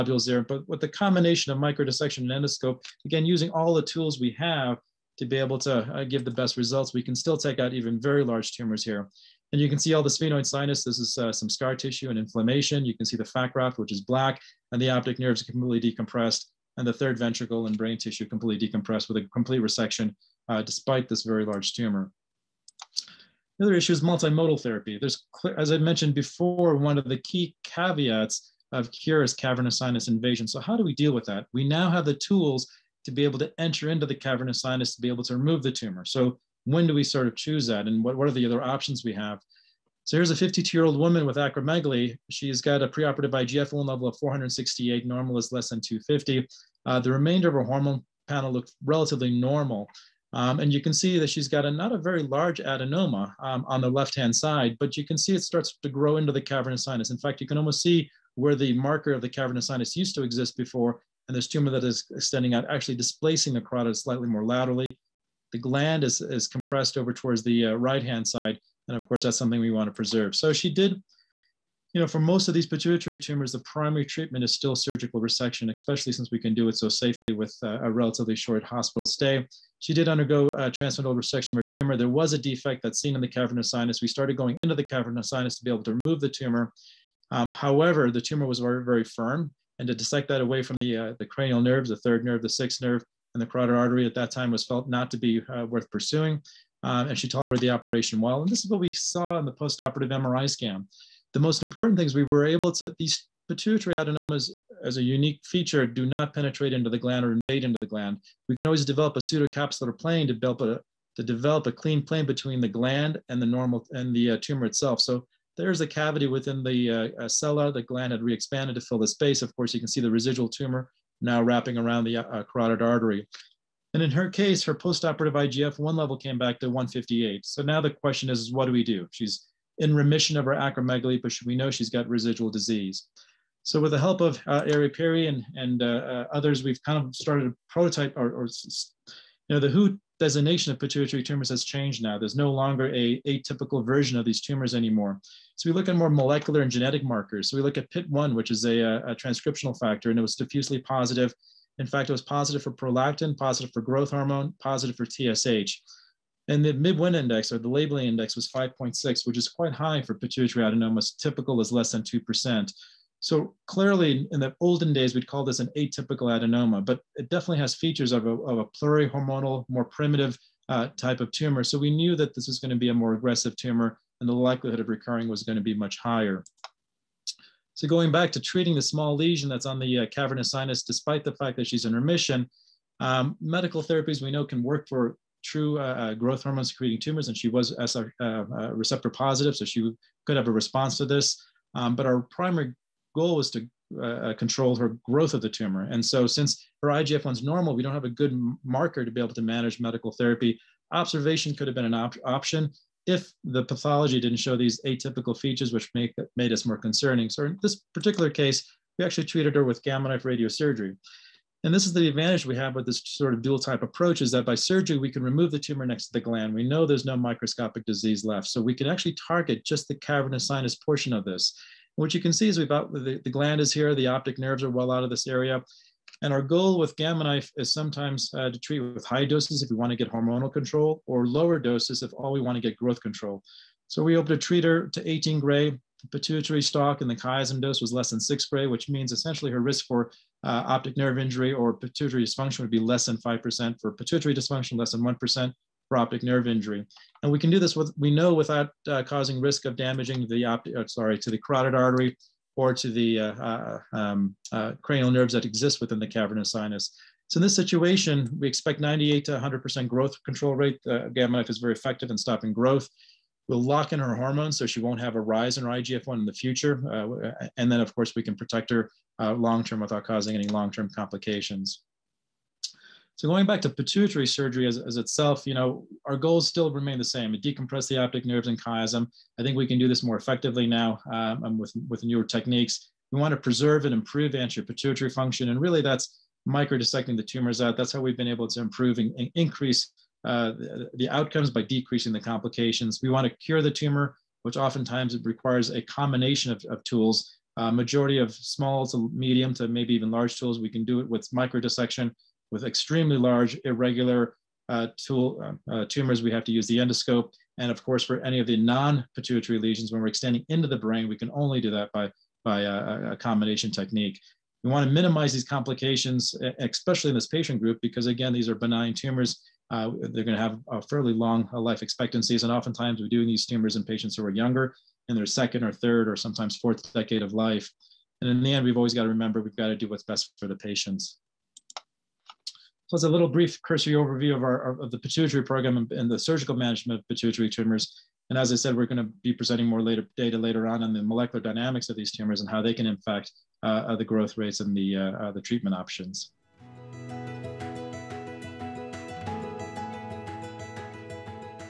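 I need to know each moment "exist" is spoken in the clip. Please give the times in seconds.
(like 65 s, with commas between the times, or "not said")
60 s, 255 s.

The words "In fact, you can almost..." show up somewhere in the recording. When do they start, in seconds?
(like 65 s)
57 s.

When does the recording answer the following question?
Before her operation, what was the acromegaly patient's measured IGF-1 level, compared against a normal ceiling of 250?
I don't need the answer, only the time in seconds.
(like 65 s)
44 s.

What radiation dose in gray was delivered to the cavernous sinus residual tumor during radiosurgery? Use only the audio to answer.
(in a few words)
18 gray.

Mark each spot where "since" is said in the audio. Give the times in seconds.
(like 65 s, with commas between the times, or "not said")
76 s, 196 s.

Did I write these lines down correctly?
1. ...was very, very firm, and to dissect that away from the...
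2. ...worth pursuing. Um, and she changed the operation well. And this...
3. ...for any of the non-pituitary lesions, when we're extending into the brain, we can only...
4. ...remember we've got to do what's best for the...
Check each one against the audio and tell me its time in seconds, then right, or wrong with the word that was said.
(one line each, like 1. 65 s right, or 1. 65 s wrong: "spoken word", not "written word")
1. 88 s right
2. 95 s wrong: "tolerated", not "changed"
3. 308 s right
4. 329 s right.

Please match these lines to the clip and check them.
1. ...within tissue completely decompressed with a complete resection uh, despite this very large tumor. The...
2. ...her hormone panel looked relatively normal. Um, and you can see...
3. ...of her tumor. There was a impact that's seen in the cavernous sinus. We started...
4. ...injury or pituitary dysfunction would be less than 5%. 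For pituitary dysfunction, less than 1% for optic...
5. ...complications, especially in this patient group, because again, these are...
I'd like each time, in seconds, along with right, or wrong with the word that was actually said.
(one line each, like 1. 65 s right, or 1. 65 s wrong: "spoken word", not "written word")
1. 17 s wrong: "brain", not "within"
2. 47 s right
3. 81 s wrong: "defect", not "impact"
4. 241 s right
5. 315 s right.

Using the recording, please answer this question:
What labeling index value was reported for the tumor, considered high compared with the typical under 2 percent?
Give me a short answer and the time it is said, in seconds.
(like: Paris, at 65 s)
5.6, at 158 s.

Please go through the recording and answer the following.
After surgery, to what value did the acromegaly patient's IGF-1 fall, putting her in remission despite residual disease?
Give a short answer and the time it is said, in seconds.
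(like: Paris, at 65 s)
158, at 126 s.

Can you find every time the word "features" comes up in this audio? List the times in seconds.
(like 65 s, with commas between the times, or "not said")
105 s, 167 s, 205 s.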